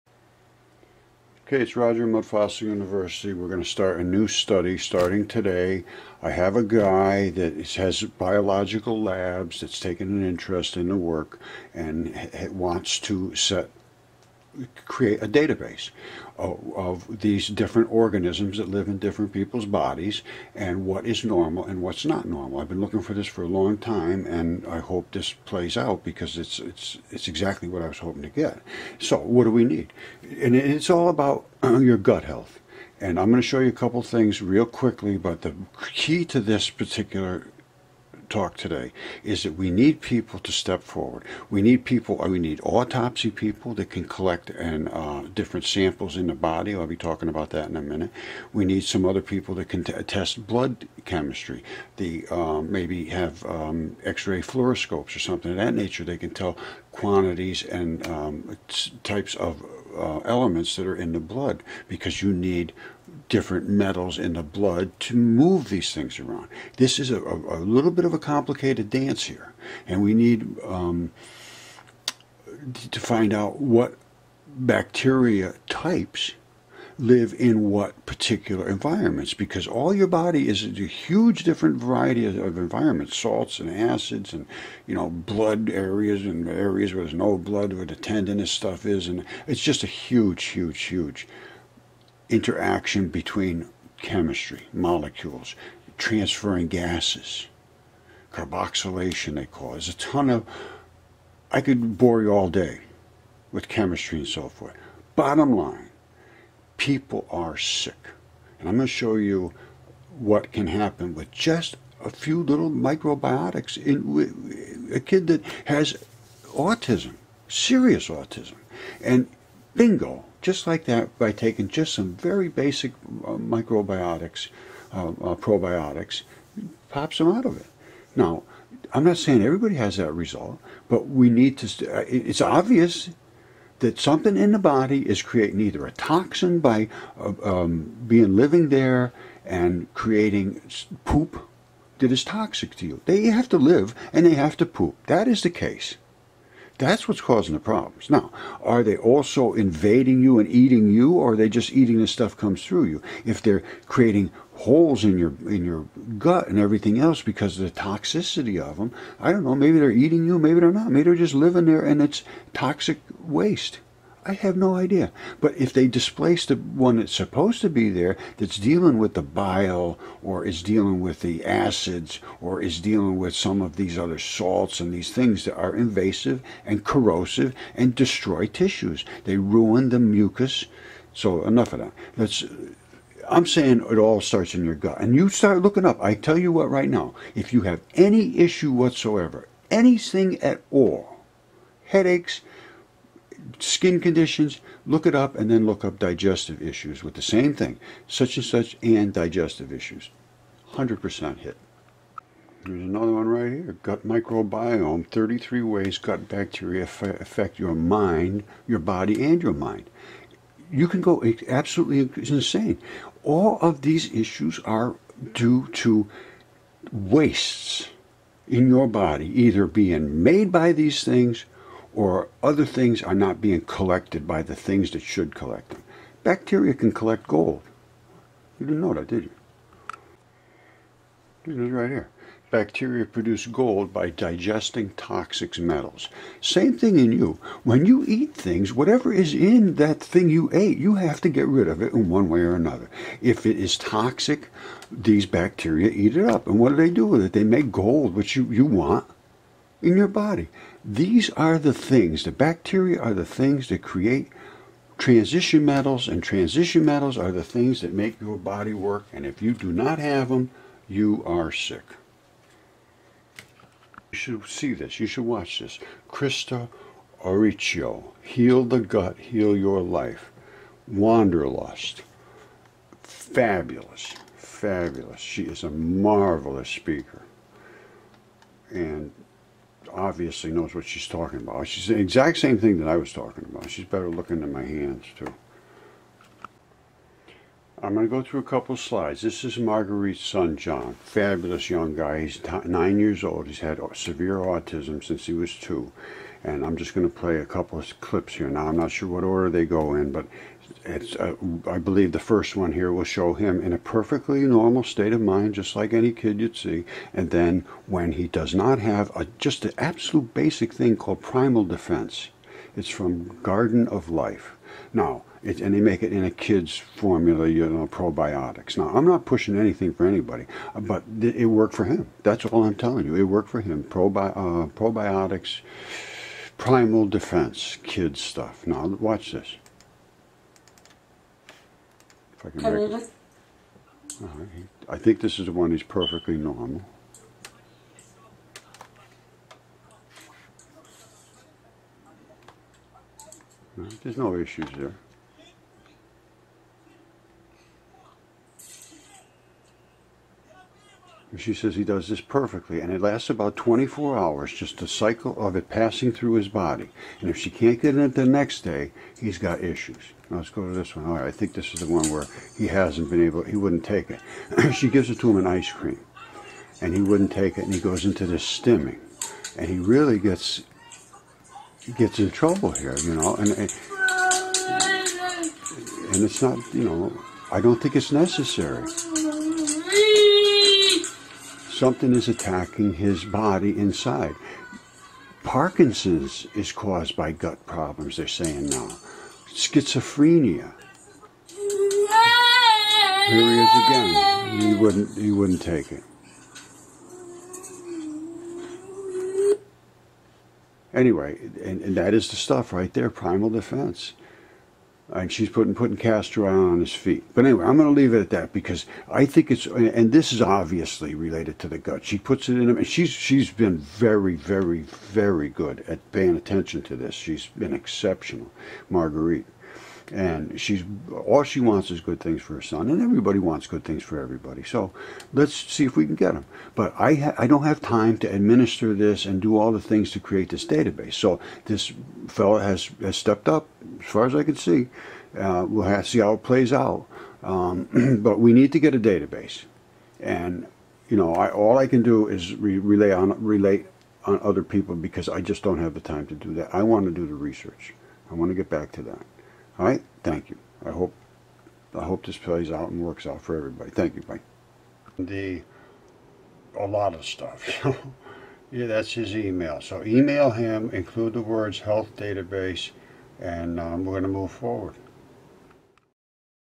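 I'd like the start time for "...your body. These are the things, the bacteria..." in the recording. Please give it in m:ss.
4:09.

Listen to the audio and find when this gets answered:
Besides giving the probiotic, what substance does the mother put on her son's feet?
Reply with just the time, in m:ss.
6:45.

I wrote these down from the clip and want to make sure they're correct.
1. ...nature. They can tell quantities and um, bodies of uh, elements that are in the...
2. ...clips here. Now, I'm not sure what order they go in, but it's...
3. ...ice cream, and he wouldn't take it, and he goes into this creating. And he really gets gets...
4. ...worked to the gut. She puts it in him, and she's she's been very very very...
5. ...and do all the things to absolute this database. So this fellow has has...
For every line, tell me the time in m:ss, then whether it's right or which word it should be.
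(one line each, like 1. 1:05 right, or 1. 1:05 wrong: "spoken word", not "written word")
1. 0:55 wrong: "types", not "bodies"
2. 4:58 right
3. 6:05 wrong: "stimming", not "creating"
4. 6:51 wrong: "related", not "worked"
5. 7:09 wrong: "create", not "absolute".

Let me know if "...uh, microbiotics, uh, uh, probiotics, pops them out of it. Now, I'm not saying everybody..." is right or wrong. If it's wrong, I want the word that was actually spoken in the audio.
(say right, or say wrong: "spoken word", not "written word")
right.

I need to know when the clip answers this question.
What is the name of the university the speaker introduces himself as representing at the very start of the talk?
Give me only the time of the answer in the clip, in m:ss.
0:02.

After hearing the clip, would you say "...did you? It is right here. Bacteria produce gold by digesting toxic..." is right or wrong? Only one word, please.
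right.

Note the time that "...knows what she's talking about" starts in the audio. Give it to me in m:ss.
4:40.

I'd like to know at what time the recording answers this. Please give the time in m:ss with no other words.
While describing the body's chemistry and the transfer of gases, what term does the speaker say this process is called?
1:38.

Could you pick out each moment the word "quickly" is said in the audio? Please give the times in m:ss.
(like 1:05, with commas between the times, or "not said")
0:34.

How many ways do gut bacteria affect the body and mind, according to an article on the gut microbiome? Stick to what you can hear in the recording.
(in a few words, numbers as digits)
33.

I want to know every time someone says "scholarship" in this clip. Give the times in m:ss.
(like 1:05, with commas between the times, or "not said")
not said.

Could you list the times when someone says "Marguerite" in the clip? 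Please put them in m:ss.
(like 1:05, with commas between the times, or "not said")
4:49, 6:58.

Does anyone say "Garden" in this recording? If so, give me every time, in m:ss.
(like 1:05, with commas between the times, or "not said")
5:13.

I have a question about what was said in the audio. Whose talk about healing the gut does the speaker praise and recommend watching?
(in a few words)
Krista Auricio.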